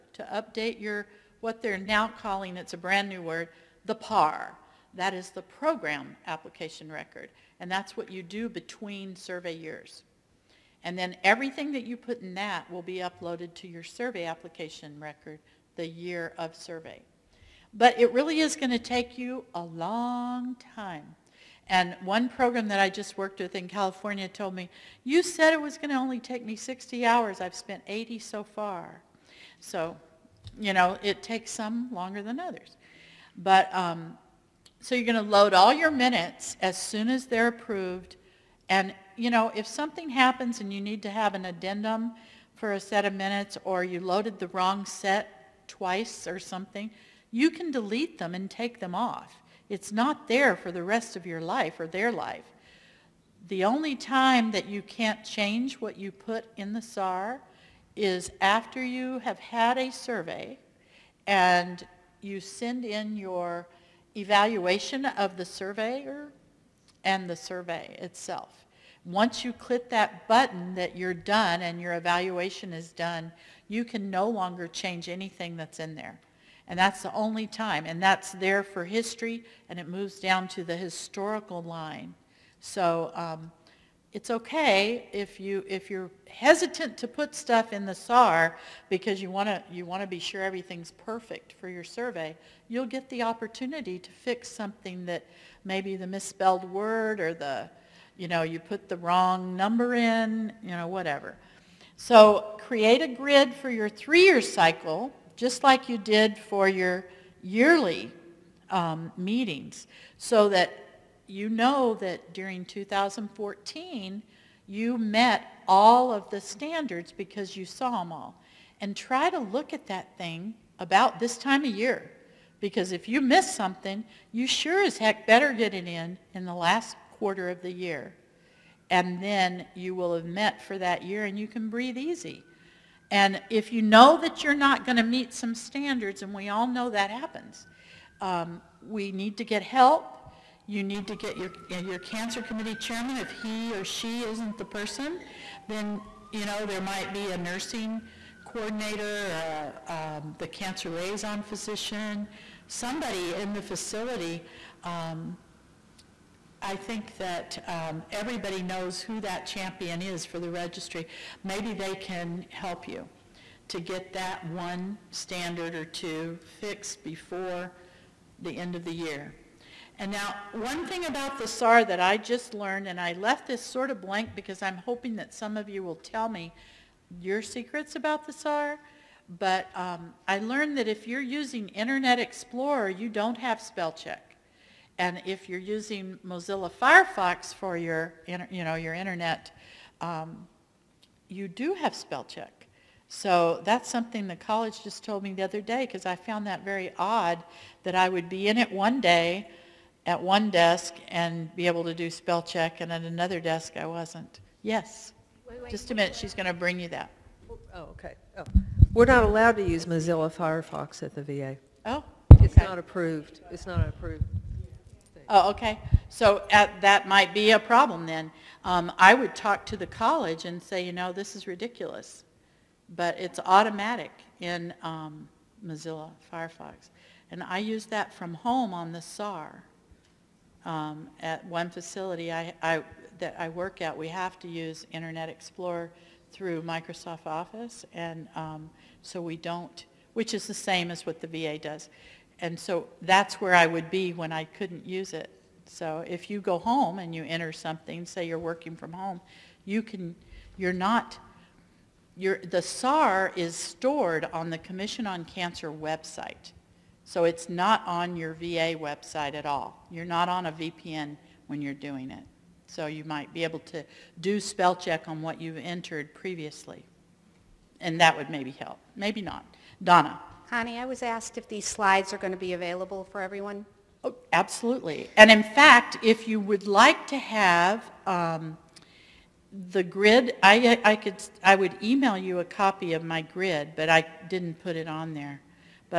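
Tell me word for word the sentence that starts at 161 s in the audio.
Maybe they can help you to get that one standard or two fixed before the end of the year.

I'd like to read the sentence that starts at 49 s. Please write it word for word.
It's not there for the rest of your life or their life.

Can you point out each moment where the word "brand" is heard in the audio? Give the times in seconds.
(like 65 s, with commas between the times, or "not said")
2 s.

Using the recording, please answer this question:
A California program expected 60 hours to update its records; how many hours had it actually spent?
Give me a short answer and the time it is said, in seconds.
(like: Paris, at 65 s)
80, at 27 s.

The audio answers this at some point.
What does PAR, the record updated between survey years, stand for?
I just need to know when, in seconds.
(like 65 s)
5 s.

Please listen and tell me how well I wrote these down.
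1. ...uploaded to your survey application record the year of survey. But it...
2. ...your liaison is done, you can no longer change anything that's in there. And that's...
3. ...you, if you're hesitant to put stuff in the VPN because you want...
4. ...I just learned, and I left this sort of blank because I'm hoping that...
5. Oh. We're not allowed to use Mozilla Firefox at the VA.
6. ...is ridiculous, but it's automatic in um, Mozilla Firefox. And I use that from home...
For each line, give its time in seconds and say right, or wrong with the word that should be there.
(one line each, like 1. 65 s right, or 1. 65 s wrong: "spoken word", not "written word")
1. 12 s right
2. 71 s wrong: "evaluation", not "liaison"
3. 85 s wrong: "SAR", not "VPN"
4. 171 s right
5. 208 s right
6. 221 s right.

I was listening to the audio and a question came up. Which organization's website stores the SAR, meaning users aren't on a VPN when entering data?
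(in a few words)
Commission on Cancer.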